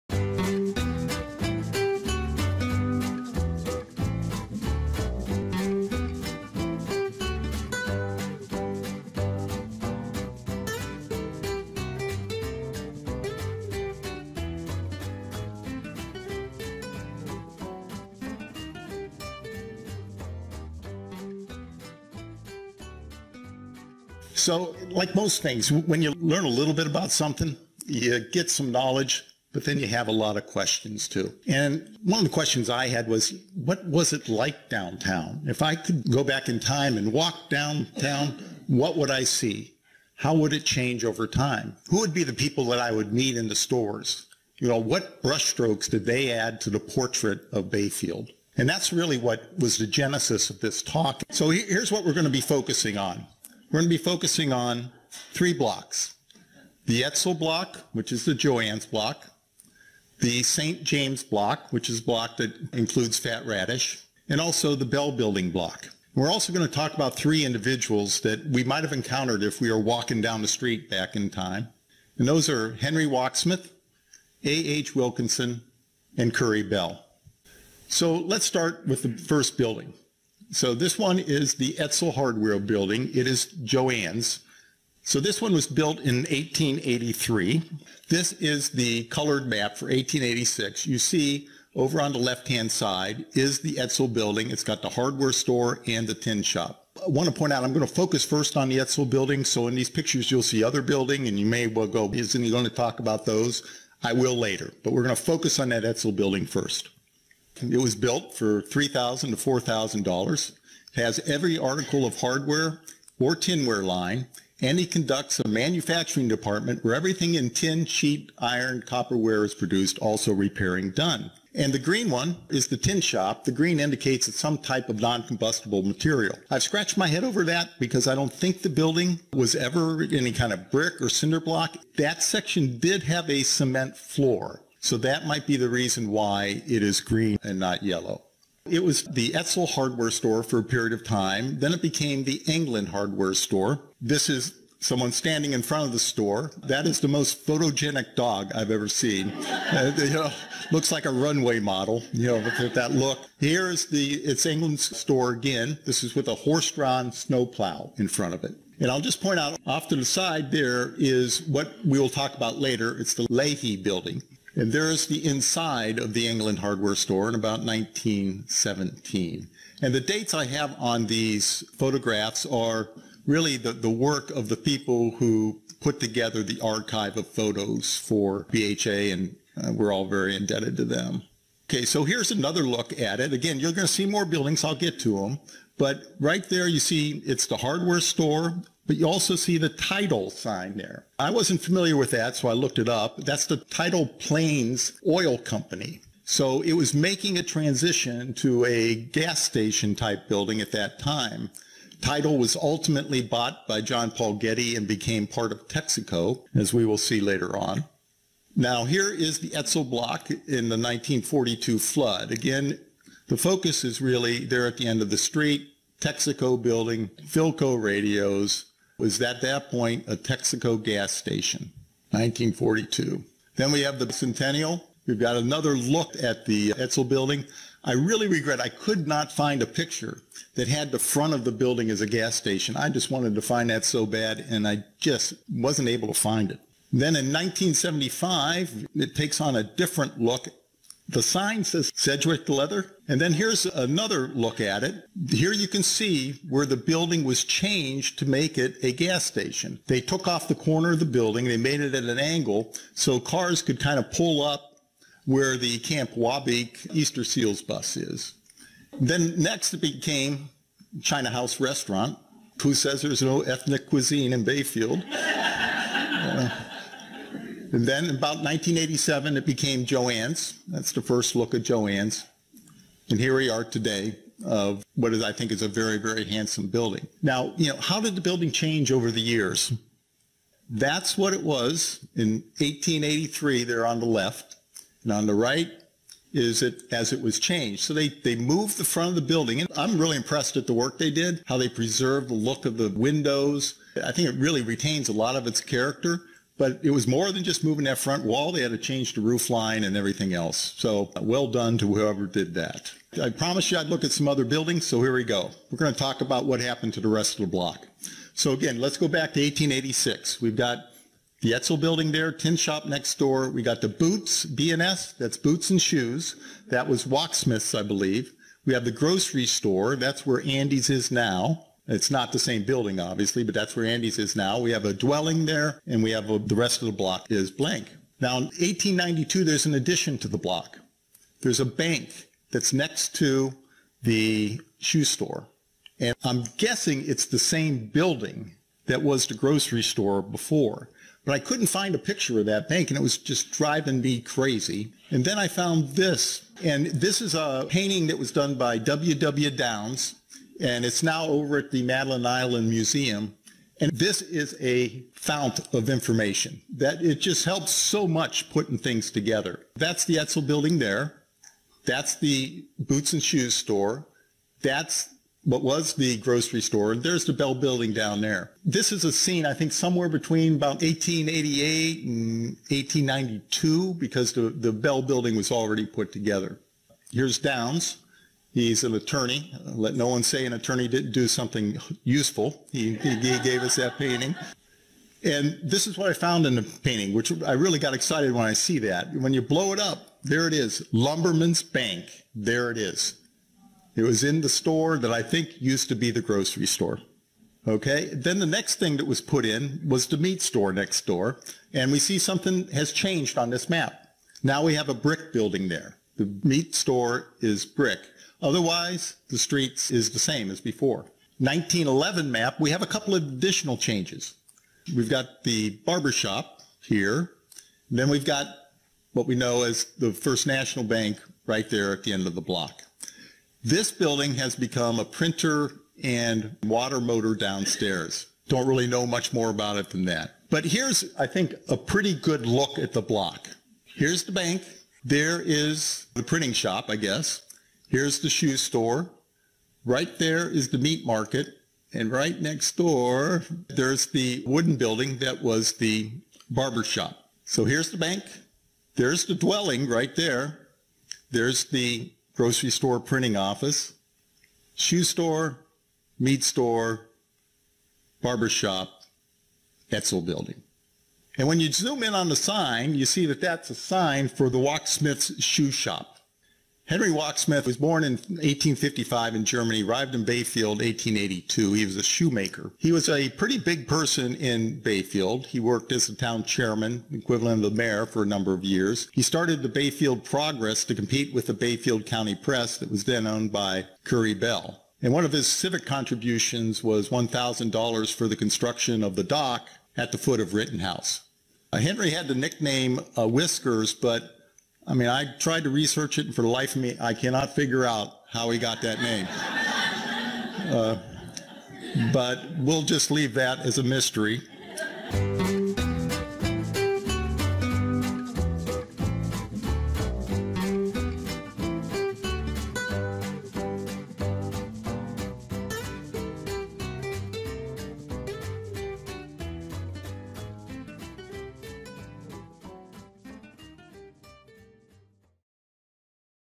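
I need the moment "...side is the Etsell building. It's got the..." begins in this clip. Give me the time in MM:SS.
01:32.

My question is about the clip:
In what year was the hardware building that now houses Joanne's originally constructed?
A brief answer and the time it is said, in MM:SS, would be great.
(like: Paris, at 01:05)
1883, at 01:25.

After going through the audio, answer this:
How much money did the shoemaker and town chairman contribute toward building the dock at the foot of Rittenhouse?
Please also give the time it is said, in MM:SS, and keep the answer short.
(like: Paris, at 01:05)
$1,000, at 08:07.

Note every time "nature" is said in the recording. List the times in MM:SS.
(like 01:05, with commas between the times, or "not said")
not said.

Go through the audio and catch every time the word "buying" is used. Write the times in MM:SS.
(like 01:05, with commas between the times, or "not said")
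not said.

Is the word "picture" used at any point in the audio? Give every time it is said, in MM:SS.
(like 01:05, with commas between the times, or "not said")
01:39, 03:49, 05:41.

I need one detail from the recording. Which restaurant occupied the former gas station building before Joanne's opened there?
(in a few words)
China House Restaurant.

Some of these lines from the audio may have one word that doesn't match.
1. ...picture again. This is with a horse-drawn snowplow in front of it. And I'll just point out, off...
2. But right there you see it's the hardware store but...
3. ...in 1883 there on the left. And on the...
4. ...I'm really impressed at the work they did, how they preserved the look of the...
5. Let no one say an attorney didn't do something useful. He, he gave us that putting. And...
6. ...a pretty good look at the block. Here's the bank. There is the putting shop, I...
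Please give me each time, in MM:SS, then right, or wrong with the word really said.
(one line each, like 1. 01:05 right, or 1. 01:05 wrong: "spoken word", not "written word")
1. 02:34 wrong: "store", not "picture"
2. 03:05 right
3. 04:42 right
4. 04:49 right
5. 06:19 wrong: "painting", not "putting"
6. 07:11 wrong: "printing", not "putting".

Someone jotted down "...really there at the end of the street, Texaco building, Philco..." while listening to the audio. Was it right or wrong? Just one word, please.
right.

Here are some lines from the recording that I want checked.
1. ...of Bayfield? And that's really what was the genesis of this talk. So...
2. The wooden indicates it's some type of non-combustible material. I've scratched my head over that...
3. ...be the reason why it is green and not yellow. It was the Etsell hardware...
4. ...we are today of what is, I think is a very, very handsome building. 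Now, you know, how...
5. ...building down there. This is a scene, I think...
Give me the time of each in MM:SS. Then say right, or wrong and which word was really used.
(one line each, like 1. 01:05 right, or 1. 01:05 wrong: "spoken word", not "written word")
1. 00:47 right
2. 02:03 wrong: "green", not "wooden"
3. 02:15 right
4. 04:33 right
5. 06:07 right.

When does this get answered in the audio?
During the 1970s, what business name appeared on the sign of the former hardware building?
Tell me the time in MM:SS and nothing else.
04:01.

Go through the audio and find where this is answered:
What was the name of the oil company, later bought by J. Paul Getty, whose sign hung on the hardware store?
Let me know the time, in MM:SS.
03:13.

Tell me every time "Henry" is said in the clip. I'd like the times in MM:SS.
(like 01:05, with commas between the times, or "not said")
01:12, 07:46, 08:11.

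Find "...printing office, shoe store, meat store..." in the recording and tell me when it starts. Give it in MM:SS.
07:33.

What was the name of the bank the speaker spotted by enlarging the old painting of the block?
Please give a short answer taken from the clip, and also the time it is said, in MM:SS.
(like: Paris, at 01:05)
Lumberman's Bank, at 06:30.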